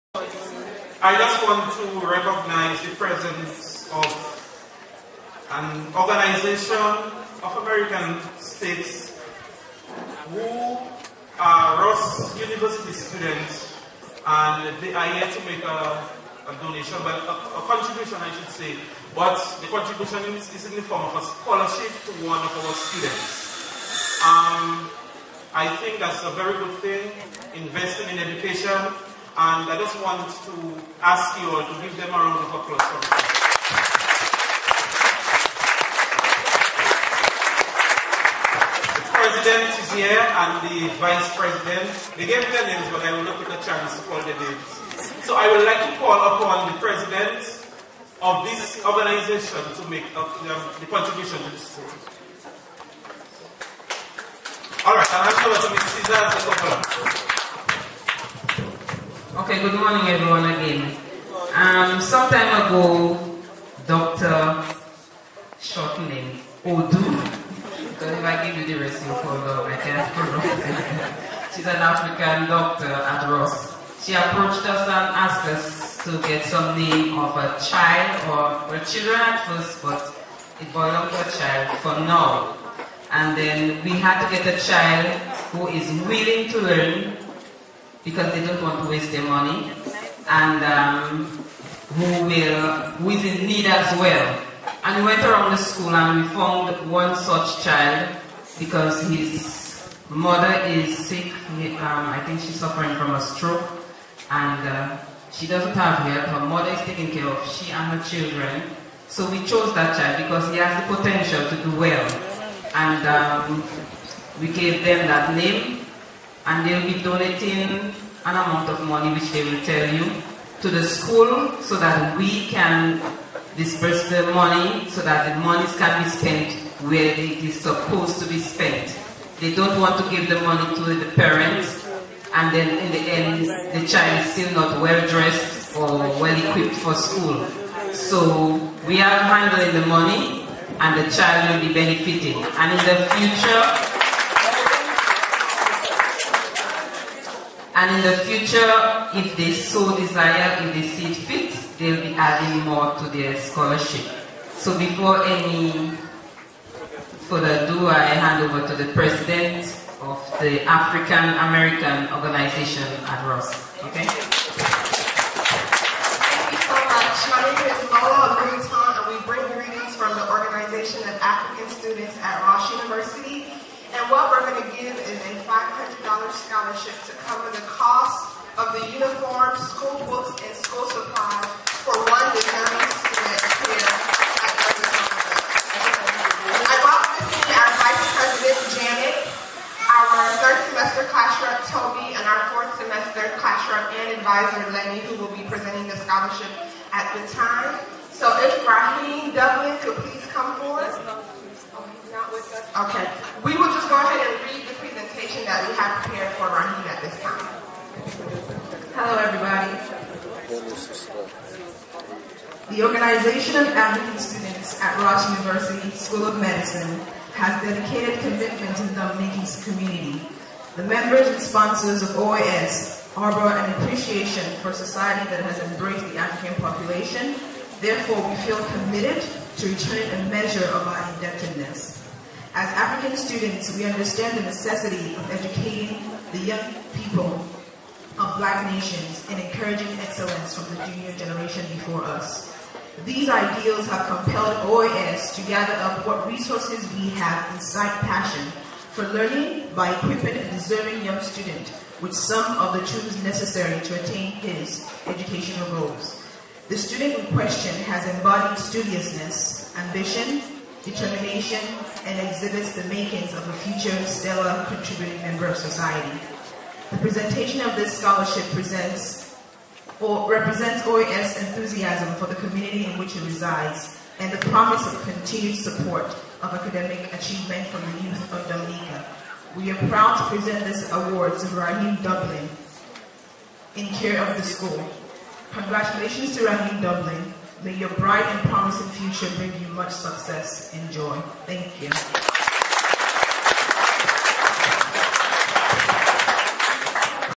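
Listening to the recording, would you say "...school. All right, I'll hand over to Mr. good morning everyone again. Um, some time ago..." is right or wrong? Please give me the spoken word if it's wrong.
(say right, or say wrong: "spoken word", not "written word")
right.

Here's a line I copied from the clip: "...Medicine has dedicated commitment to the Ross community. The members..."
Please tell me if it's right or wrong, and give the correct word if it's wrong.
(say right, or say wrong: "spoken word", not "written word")
wrong: "Dominican", not "Ross".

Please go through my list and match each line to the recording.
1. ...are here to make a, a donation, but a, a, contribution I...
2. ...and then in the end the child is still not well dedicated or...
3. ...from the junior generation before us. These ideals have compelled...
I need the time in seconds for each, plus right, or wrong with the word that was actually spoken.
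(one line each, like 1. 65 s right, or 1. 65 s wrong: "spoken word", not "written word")
1. 14 s right
2. 132 s wrong: "dressed", not "dedicated"
3. 240 s right.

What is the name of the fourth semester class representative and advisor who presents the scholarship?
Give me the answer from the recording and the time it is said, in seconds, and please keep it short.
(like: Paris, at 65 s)
Lenny, at 194 s.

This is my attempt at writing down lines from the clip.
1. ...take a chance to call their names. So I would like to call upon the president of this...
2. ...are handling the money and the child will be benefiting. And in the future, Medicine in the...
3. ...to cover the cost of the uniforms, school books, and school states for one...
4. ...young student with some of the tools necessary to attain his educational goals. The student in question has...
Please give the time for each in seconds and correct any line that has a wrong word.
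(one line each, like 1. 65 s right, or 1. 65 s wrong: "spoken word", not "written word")
1. 43 s right
2. 138 s wrong: "And", not "Medicine"
3. 177 s wrong: "supplies", not "states"
4. 251 s right.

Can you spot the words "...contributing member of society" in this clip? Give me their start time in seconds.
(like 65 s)
264 s.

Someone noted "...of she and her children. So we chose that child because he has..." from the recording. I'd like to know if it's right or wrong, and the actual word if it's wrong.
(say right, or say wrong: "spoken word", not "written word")
right.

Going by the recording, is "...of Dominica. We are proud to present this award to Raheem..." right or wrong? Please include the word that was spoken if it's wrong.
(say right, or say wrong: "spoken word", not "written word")
right.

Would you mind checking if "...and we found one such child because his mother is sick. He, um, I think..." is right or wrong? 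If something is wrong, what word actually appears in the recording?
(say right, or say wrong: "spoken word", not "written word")
right.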